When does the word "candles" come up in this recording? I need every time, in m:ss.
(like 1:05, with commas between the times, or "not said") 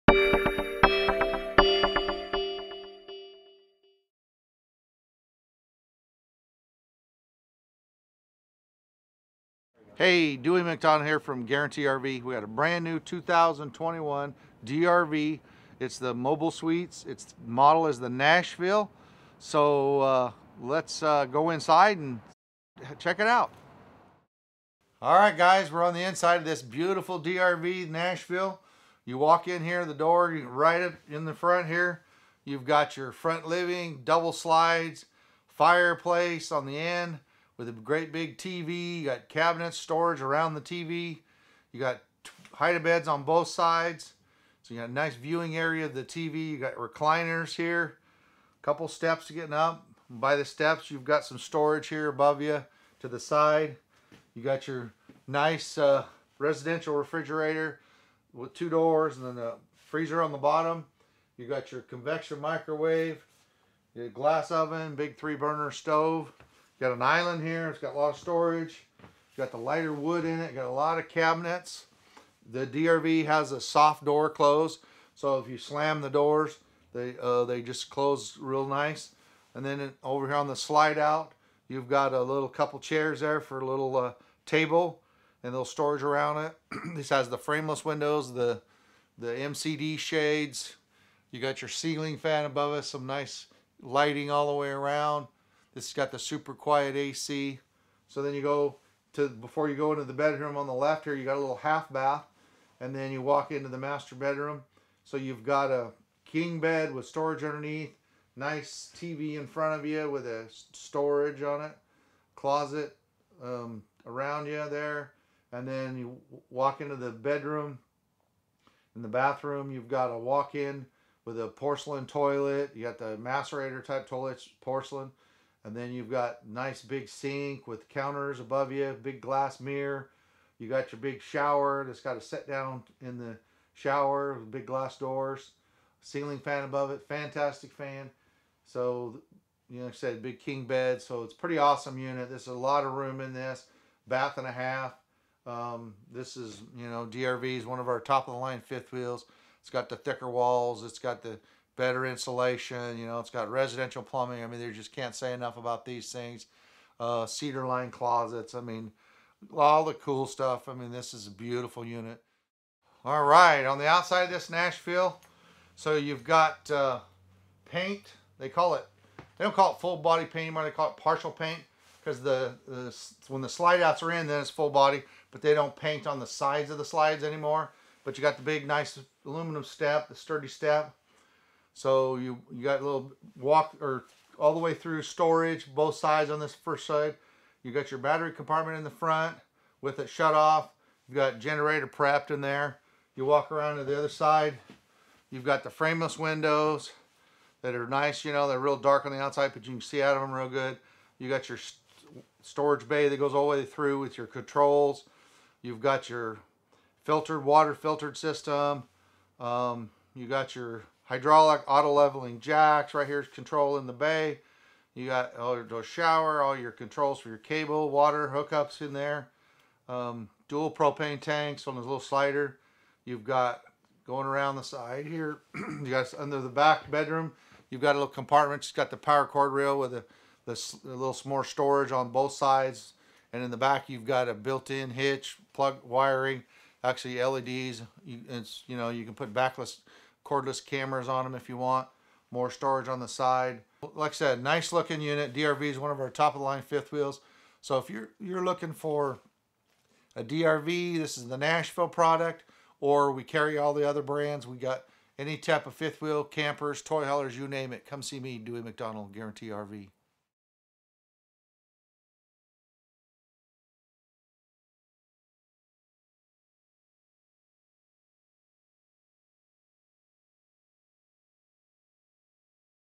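not said.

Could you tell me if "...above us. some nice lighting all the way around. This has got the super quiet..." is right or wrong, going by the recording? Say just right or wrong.
right.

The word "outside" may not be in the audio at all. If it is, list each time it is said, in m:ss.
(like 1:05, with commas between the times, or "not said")
2:43, 3:19.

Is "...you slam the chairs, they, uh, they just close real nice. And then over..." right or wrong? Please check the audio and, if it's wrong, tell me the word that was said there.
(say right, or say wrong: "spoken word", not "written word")
wrong: "doors", not "chairs".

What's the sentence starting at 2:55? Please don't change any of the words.
But they don't paint on the sides of the slides anymore.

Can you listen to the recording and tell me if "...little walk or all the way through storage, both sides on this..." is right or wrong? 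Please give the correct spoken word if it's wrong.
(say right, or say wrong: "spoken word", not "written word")
right.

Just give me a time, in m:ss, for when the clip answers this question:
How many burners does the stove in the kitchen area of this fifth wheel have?
1:04.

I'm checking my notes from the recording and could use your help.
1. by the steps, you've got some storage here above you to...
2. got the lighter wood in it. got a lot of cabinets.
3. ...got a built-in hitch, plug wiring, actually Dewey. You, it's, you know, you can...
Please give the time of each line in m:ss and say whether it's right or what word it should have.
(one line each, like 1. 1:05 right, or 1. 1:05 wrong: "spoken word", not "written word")
1. 0:50 right
2. 1:09 right
3. 3:54 wrong: "LEDs", not "Dewey".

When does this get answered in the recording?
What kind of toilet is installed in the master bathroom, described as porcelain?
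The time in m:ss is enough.
2:03.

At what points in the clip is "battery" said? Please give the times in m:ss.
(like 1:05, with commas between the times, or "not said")
3:07.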